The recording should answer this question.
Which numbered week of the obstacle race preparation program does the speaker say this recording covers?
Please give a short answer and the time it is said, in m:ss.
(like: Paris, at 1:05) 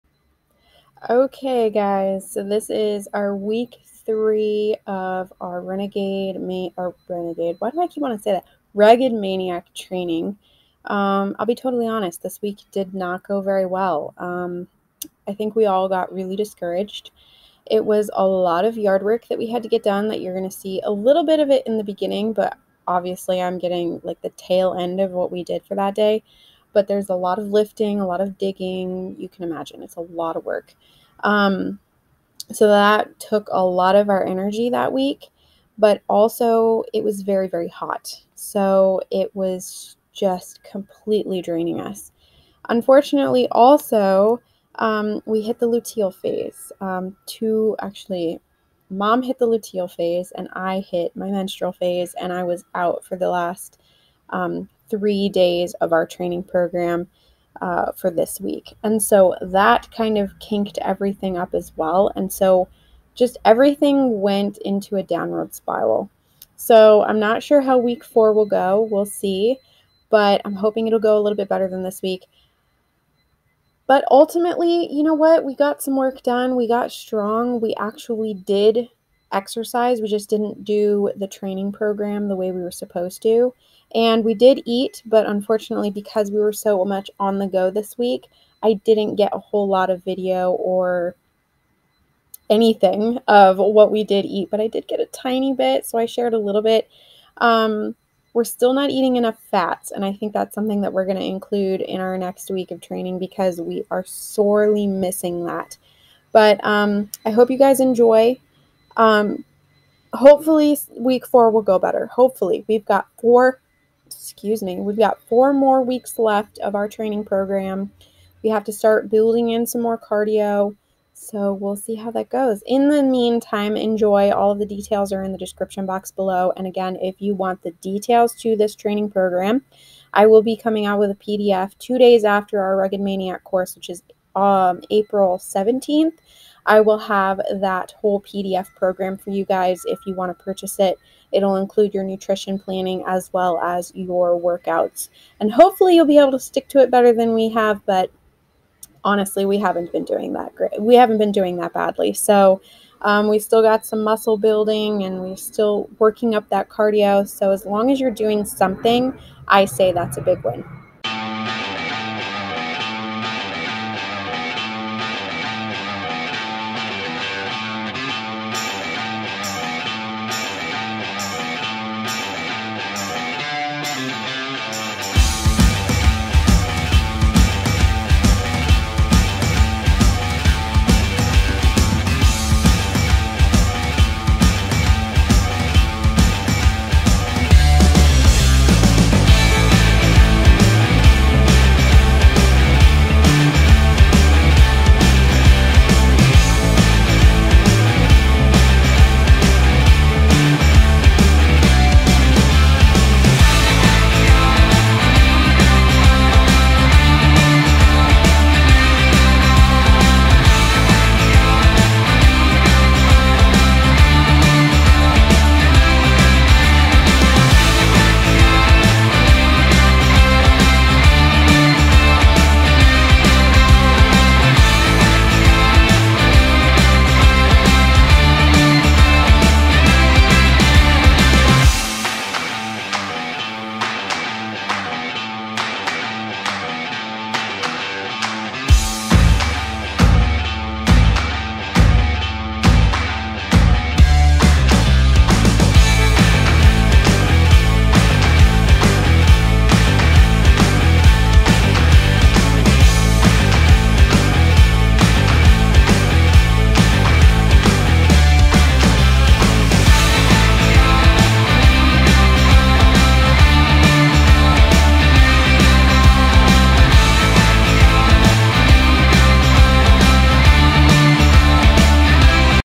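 week three, at 0:03.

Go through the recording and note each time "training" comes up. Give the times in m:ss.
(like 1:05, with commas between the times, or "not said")
0:09, 0:56, 1:21, 1:42, 1:56, 2:08.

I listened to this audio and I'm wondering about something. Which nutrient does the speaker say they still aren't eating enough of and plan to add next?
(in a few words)
fats.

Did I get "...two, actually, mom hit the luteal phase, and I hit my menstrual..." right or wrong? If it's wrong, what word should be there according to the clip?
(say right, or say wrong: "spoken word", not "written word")
right.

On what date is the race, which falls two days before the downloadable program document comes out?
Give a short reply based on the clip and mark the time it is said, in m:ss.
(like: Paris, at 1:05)
April 17th, at 2:14.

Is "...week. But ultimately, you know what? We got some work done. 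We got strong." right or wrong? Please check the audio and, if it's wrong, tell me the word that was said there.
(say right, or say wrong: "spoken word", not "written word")
right.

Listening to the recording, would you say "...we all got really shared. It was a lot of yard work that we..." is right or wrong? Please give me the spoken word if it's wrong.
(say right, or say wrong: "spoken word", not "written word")
wrong: "discouraged", not "shared".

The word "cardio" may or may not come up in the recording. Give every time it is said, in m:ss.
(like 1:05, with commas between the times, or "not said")
1:59, 2:36.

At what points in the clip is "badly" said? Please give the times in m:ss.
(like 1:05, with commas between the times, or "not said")
2:31.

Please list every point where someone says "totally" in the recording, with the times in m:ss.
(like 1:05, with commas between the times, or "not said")
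0:11.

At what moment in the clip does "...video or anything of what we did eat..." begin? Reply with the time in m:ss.
1:30.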